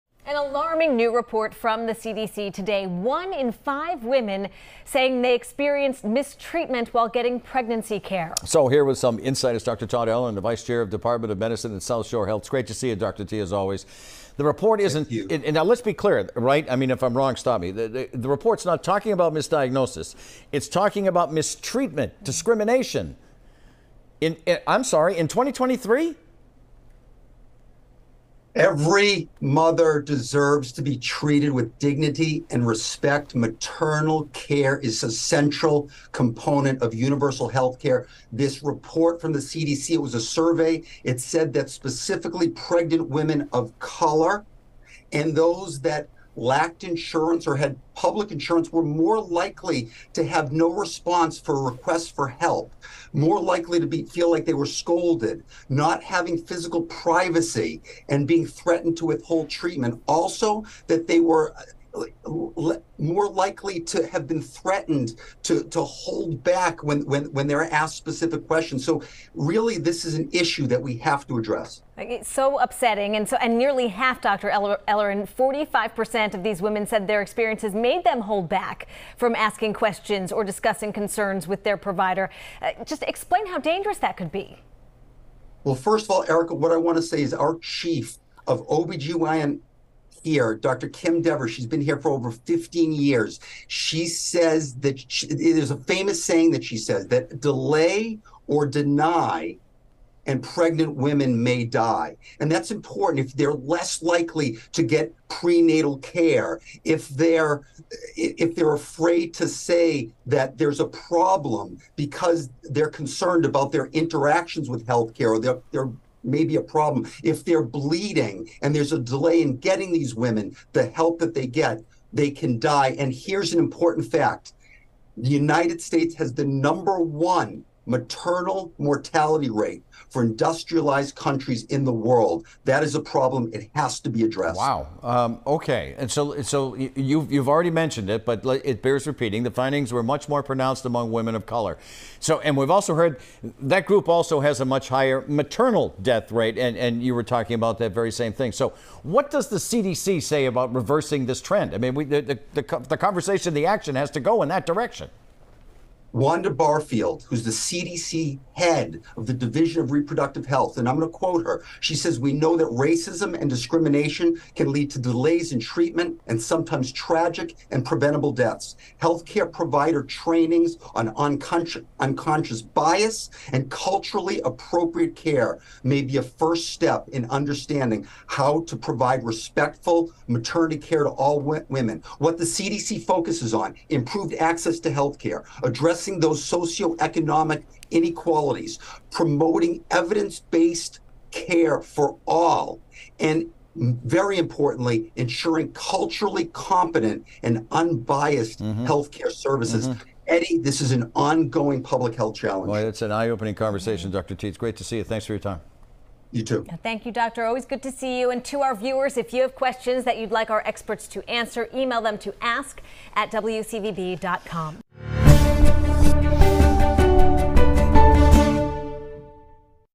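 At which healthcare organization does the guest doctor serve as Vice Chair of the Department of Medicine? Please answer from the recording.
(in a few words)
South Shore Health.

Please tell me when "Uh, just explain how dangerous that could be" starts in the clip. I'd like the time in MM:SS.
01:22.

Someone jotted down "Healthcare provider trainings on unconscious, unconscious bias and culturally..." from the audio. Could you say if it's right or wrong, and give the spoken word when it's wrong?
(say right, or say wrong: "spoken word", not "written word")
right.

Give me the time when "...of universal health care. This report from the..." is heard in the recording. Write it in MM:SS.
00:36.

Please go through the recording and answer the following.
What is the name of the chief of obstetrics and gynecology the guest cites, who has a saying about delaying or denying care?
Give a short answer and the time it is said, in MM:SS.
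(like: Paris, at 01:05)
Kim Dever, at 01:30.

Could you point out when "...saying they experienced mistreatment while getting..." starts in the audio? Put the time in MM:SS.
00:04.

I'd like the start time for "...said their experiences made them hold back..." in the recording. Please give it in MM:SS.
01:16.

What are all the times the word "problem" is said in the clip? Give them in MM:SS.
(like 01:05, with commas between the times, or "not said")
01:50, 01:56, 02:12.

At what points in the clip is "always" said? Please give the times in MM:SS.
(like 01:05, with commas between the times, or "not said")
00:13, 03:27.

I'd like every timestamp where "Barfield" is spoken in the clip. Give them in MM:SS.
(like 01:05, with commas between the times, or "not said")
02:36.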